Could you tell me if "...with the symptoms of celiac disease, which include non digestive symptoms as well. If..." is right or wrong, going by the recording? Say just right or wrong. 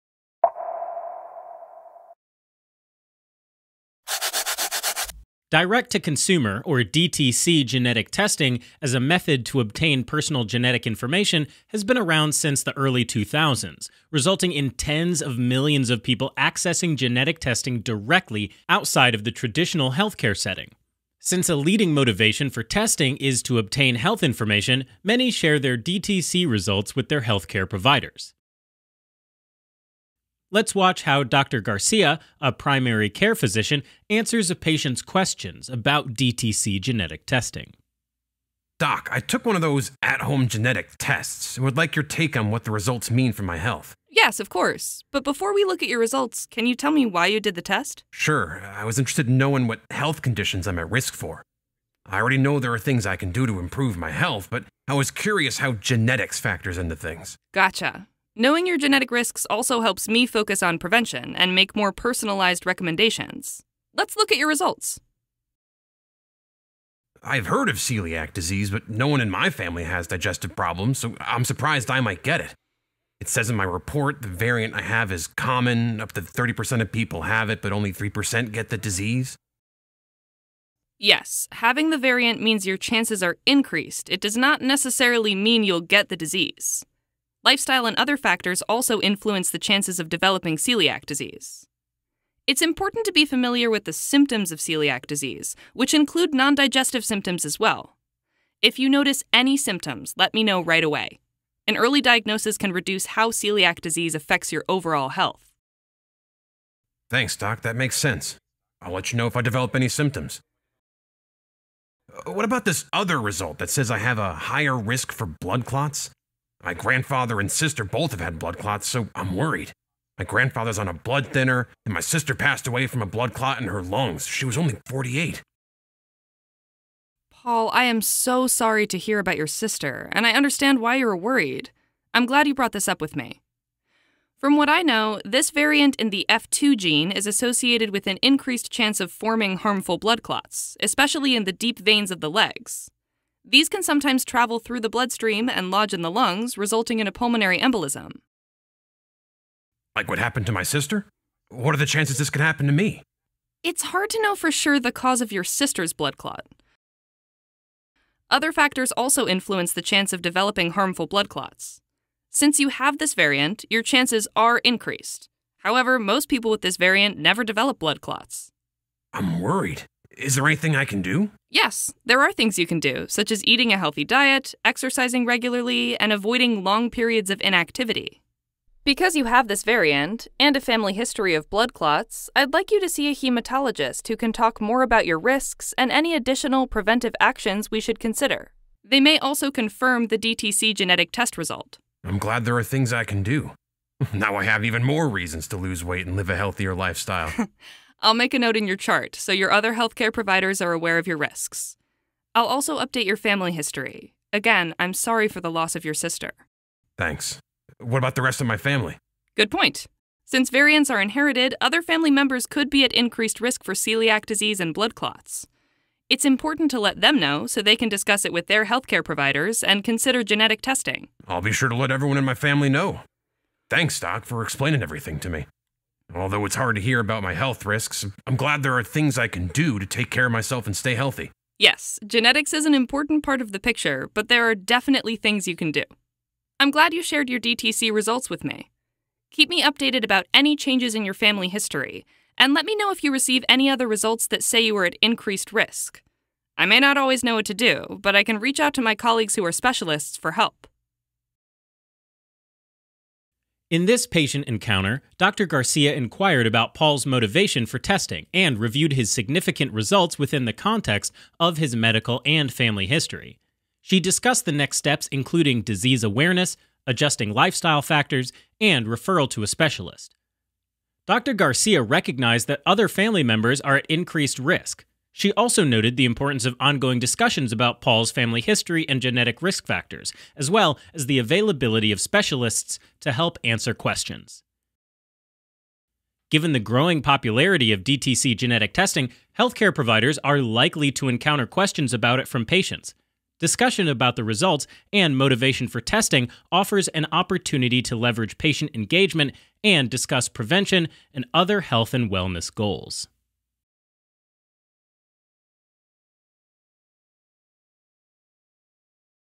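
right.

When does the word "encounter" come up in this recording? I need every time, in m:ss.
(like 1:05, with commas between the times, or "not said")
4:14, 4:51.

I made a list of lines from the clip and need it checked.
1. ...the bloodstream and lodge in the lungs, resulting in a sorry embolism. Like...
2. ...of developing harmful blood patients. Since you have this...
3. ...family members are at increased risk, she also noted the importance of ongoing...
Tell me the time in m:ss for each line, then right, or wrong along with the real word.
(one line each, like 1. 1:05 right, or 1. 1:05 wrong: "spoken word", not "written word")
1. 2:24 wrong: "pulmonary", not "sorry"
2. 2:40 wrong: "clots", not "patients"
3. 4:32 right.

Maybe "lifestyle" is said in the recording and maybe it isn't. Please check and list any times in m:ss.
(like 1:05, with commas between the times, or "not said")
1:27, 3:16, 4:27.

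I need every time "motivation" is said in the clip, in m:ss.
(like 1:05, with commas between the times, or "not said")
0:21, 4:17, 4:55.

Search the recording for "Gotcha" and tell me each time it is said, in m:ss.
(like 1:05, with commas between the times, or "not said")
0:57.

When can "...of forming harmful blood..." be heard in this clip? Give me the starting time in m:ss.
2:18.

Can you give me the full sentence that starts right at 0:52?
I already know there are things I can do to improve my health, but I was curious how genetics factors into things.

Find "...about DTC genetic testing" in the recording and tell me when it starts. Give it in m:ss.
0:35.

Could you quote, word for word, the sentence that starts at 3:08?
They may also confirm the DTC genetic test result.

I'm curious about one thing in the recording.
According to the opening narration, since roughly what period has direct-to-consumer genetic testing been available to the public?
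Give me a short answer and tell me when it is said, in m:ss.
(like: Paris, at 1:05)
early 2000s, at 0:12.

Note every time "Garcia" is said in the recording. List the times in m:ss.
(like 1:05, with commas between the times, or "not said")
0:31, 4:15, 4:31.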